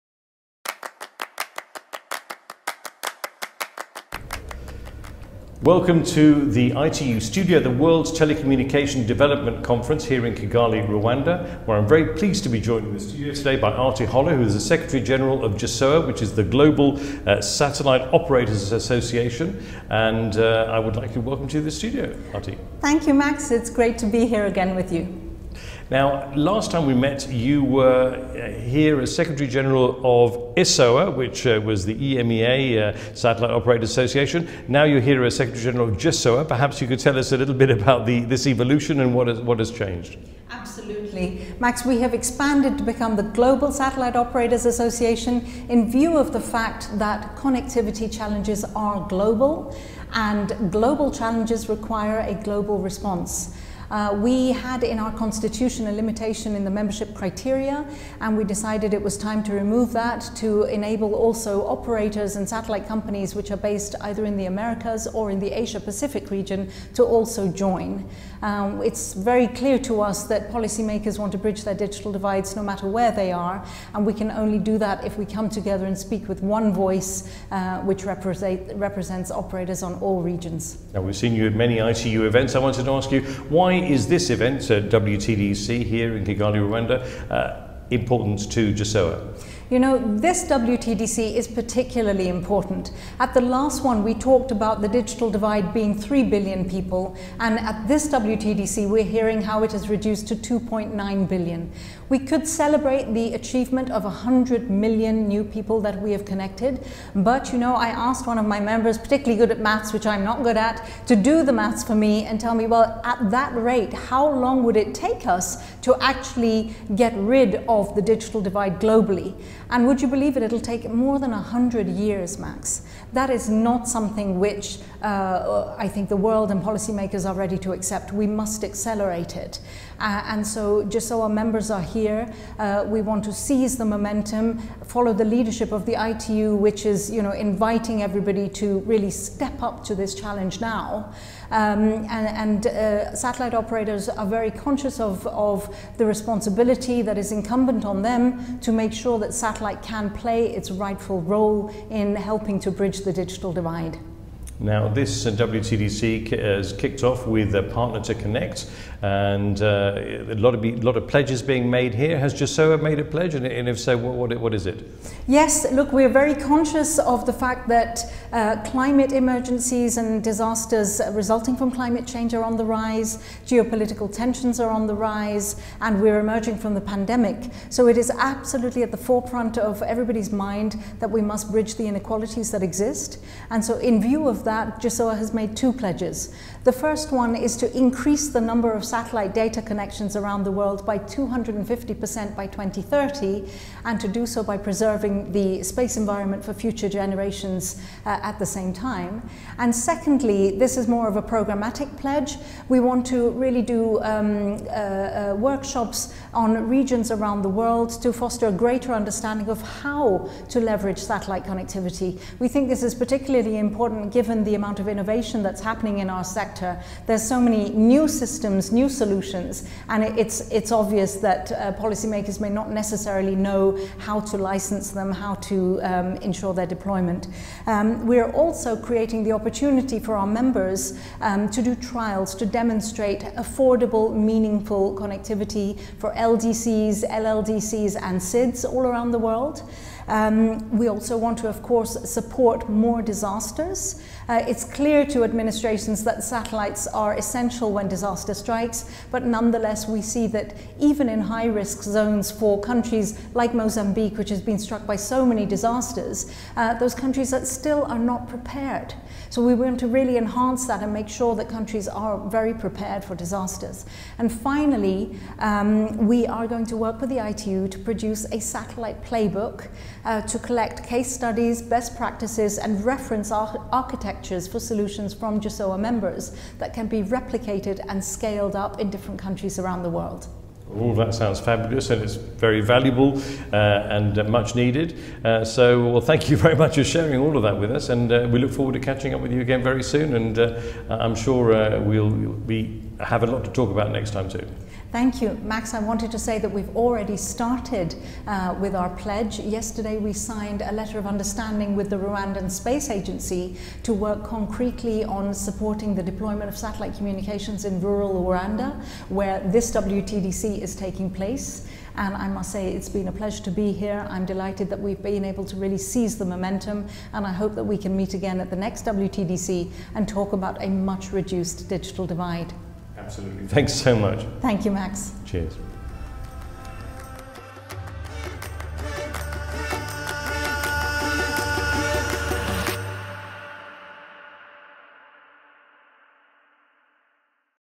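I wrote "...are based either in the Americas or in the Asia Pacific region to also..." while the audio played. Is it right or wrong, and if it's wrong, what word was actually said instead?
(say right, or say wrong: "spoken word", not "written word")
right.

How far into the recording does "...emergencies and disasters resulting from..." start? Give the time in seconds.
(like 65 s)
169 s.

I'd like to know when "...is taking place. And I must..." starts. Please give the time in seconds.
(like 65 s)
310 s.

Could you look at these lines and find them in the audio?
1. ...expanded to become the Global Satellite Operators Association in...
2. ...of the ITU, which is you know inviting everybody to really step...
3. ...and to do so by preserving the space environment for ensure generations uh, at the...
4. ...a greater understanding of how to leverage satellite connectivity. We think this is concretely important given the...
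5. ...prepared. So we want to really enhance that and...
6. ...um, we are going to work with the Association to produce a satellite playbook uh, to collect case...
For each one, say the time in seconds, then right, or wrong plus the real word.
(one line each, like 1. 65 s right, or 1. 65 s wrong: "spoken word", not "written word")
1. 42 s right
2. 135 s right
3. 193 s wrong: "future", not "ensure"
4. 208 s wrong: "particularly", not "concretely"
5. 258 s right
6. 265 s wrong: "ITU", not "Association".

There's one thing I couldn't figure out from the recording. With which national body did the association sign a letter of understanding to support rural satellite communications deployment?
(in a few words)
Rwandan Space Agency.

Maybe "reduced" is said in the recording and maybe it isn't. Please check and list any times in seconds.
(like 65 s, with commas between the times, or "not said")
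99 s, 321 s.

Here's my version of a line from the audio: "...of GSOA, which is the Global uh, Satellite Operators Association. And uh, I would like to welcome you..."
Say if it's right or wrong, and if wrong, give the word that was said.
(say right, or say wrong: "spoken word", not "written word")
right.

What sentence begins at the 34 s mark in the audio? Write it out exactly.
Now you're here as Secretary General of GSOA.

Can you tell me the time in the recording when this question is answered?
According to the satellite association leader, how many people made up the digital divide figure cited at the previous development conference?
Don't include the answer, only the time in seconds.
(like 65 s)
95 s.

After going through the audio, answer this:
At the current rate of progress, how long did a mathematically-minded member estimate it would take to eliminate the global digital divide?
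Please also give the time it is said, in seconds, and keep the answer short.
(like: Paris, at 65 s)
more than 100 years, at 120 s.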